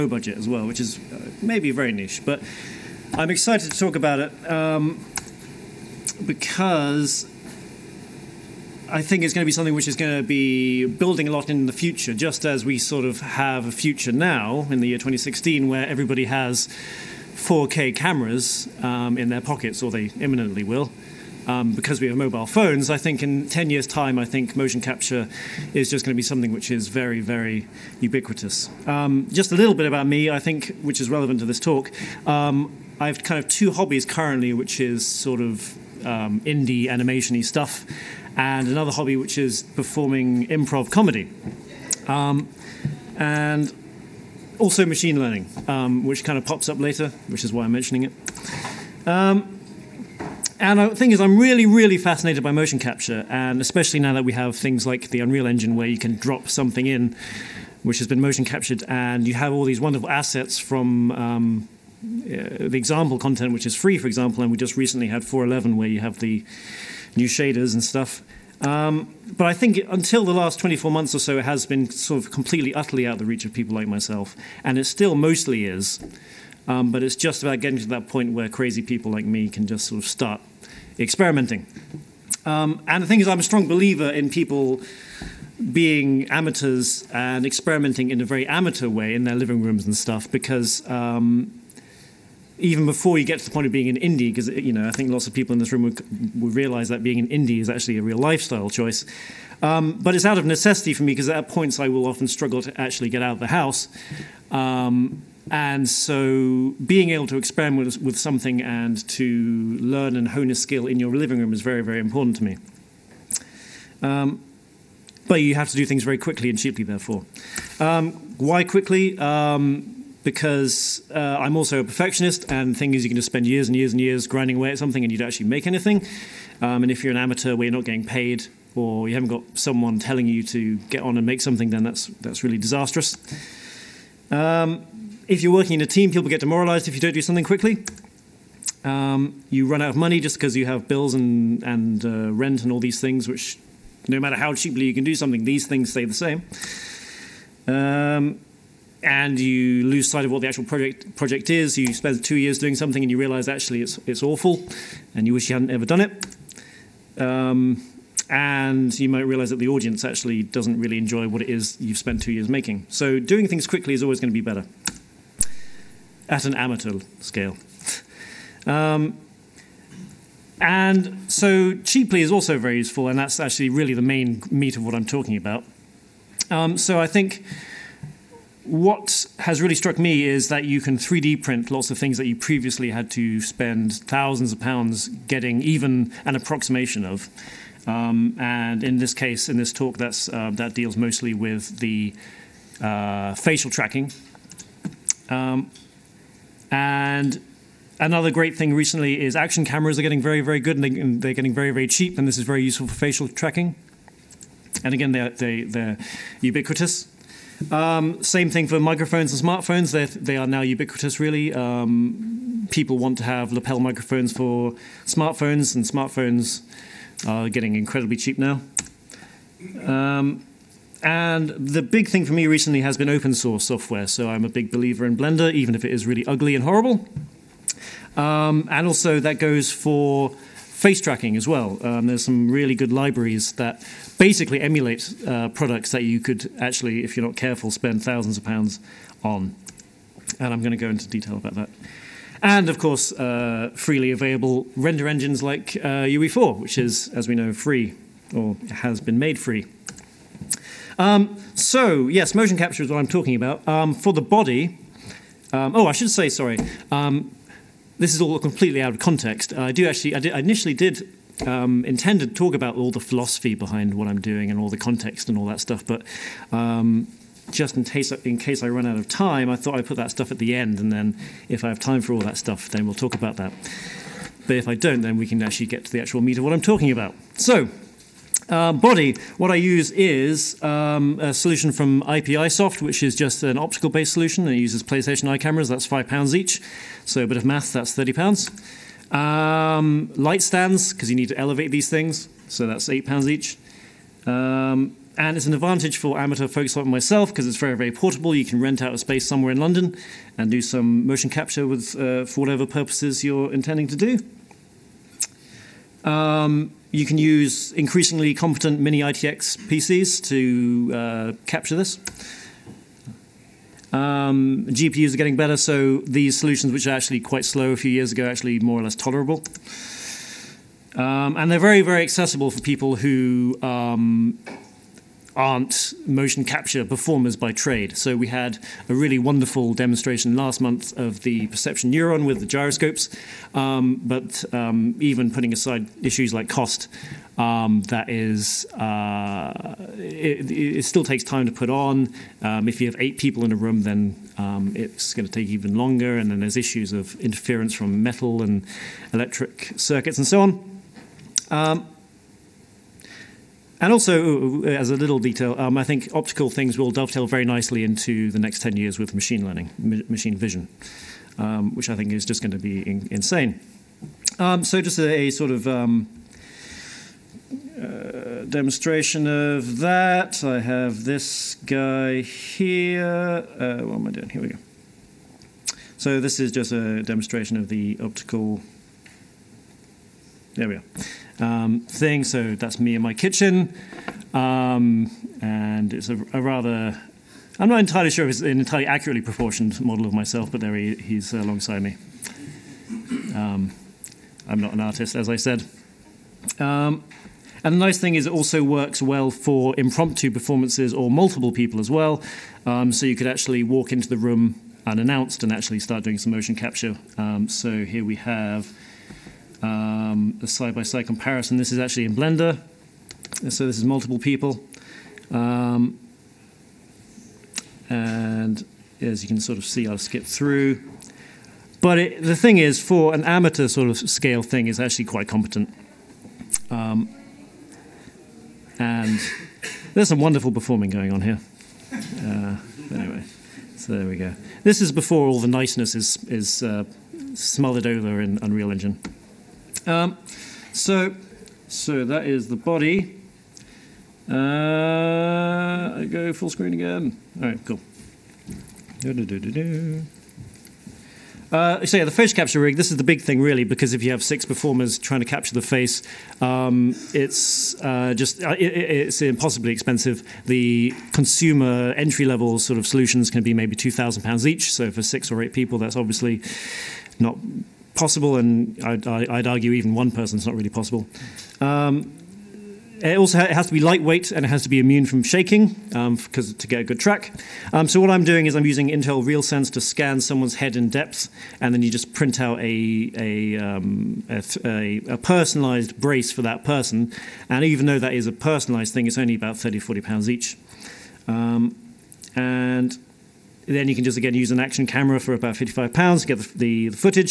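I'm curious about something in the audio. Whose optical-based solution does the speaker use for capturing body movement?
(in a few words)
iPi Soft.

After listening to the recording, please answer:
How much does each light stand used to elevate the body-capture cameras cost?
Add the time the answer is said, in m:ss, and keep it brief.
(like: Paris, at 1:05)
£8, at 4:52.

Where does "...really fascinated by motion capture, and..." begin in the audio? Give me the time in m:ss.
0:51.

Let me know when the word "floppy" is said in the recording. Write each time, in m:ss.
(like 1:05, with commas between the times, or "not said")
not said.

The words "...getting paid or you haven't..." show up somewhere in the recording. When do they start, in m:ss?
2:07.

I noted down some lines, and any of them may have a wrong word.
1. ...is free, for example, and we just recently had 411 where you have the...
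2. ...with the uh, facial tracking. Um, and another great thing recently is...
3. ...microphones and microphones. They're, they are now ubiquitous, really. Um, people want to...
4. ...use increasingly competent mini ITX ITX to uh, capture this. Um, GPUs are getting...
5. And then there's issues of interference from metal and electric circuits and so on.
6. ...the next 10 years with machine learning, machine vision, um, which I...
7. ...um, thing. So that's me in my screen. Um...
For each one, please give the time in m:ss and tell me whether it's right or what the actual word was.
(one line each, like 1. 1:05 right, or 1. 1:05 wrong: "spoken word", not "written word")
1. 1:03 right
2. 3:11 right
3. 3:28 wrong: "smartphones", not "microphones"
4. 5:07 wrong: "PCs", not "ITX"
5. 5:46 right
6. 5:58 right
7. 6:21 wrong: "kitchen", not "screen".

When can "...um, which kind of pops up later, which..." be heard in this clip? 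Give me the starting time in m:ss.
0:45.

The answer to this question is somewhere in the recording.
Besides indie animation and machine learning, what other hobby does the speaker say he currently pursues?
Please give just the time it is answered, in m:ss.
0:40.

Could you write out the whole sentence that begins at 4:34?
But if I don't, then we can actually get to the actual meat of what I'm talking about.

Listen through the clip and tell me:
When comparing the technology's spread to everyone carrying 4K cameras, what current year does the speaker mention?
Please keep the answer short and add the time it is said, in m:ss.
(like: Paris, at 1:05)
2016, at 0:14.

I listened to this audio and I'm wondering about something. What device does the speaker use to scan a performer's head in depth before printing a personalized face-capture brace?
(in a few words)
Intel RealSense.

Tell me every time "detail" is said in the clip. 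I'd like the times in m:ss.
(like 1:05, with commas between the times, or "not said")
4:01, 5:55.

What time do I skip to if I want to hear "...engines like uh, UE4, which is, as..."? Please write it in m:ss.
4:05.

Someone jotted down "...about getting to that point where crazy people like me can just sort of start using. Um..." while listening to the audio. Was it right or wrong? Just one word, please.
wrong.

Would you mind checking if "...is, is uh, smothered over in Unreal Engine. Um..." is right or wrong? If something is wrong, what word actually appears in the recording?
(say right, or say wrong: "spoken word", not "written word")
right.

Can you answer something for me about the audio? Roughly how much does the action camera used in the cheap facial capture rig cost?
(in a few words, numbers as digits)
55 pounds.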